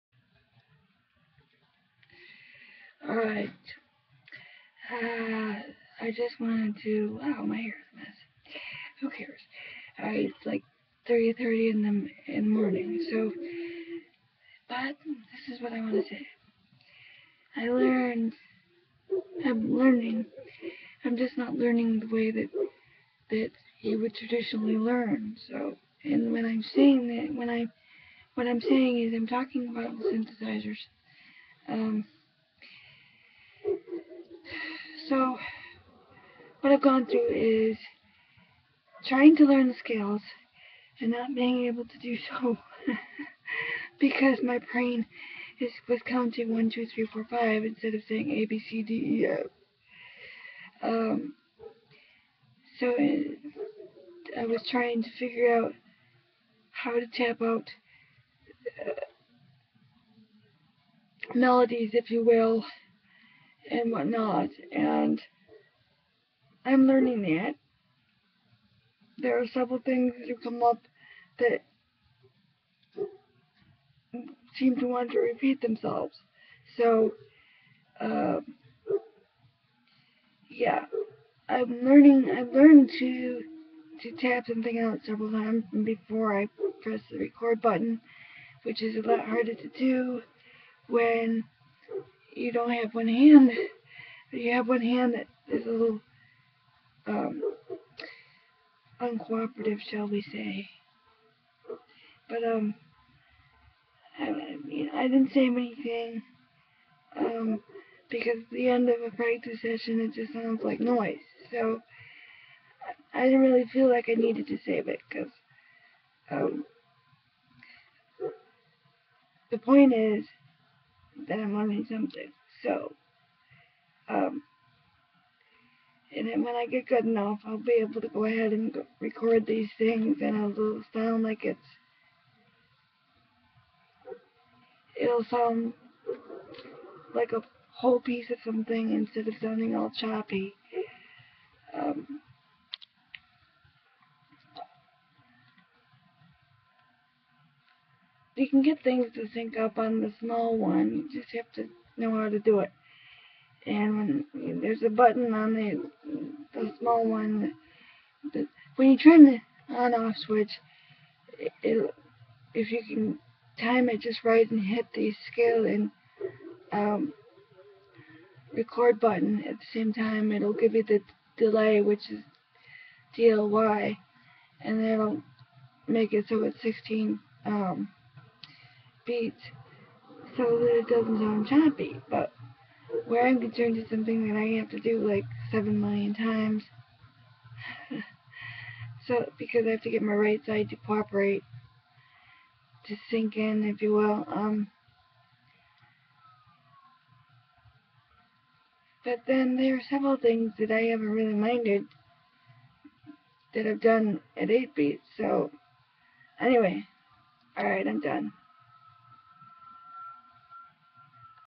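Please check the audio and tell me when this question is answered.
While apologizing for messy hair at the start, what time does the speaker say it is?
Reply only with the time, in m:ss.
0:11.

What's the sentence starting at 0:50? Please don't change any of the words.
Um, so it, I was trying to figure out how to tap out uh, melodies, if you will, and whatnot.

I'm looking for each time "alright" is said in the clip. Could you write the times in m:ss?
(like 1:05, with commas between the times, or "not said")
0:03, 3:27.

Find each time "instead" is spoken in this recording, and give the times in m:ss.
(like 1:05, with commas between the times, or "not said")
0:47, 2:18.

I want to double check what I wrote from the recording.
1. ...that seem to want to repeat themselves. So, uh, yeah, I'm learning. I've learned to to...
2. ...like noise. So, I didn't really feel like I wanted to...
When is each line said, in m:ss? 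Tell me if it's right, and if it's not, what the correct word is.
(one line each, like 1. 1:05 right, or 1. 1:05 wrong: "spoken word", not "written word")
1. 1:11 right
2. 1:50 wrong: "needed", not "wanted".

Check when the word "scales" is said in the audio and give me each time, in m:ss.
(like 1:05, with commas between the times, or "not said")
0:39, 2:45.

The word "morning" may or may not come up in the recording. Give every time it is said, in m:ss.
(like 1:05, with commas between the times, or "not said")
0:12.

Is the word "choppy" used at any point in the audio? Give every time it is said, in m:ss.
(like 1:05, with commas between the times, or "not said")
2:19, 3:01.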